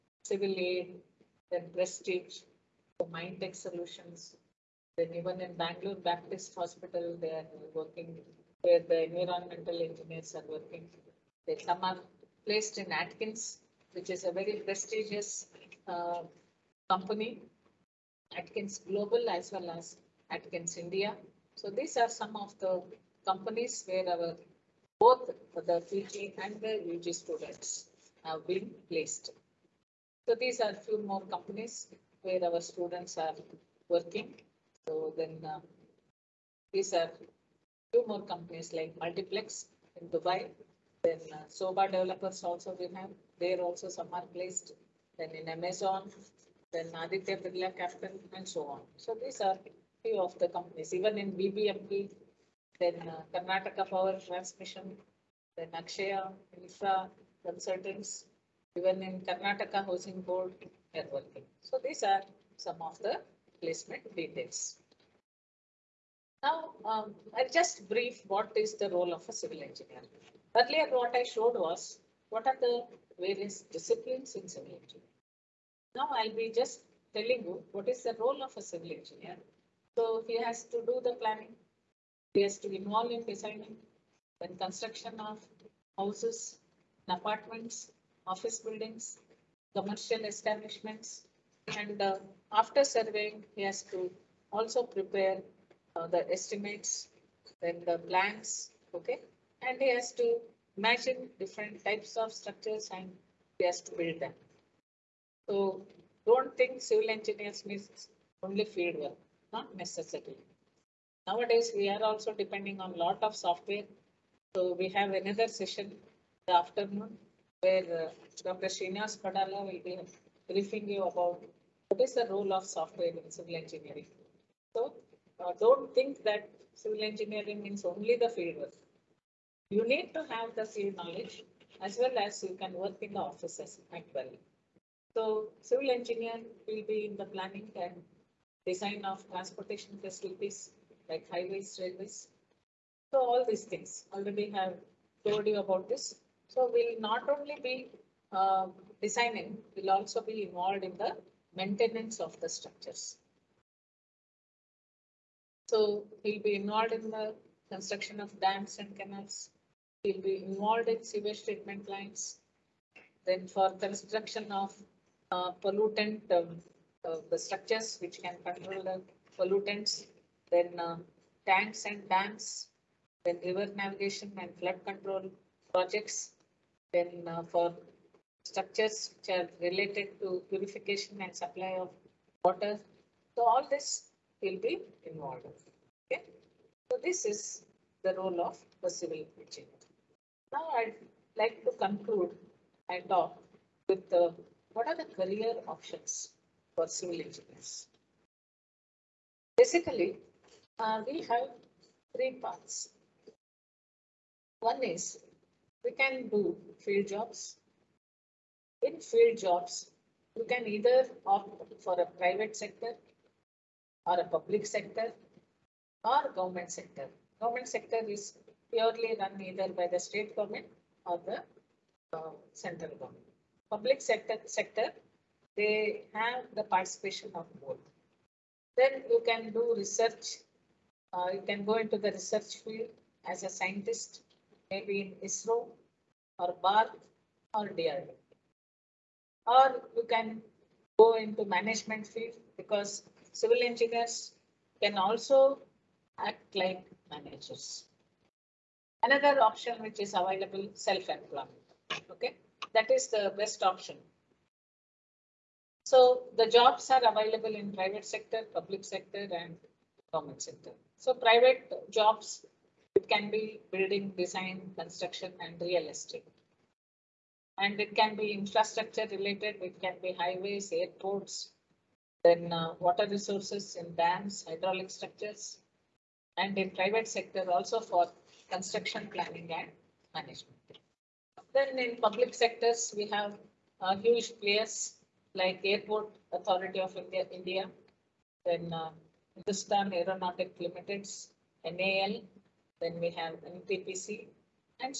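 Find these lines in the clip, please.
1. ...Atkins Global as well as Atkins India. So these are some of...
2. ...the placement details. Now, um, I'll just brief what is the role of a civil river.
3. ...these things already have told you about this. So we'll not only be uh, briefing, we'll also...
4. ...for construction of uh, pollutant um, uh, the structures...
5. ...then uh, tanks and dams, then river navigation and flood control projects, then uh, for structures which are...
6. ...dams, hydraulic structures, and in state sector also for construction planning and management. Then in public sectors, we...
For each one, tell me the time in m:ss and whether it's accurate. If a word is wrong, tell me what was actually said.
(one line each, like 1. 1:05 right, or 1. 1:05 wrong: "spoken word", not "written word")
1. 0:18 right
2. 1:02 wrong: "engineer", not "river"
3. 2:23 wrong: "designing", not "briefing"
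4. 2:43 right
5. 2:50 right
6. 4:33 wrong: "private", not "state".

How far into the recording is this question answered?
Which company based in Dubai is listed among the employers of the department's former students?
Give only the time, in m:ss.
0:38.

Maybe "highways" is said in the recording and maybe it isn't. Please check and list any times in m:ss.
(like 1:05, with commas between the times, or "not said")
2:21, 4:30.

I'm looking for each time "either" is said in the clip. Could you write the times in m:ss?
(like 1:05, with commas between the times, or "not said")
3:30, 3:39.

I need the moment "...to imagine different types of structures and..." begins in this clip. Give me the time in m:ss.
1:40.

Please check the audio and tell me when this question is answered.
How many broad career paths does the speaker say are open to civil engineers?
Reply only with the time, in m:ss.
3:22.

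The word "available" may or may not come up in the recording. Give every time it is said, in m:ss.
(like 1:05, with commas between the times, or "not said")
4:10, 4:17.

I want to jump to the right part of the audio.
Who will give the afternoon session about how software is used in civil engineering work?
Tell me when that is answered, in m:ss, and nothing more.
1:58.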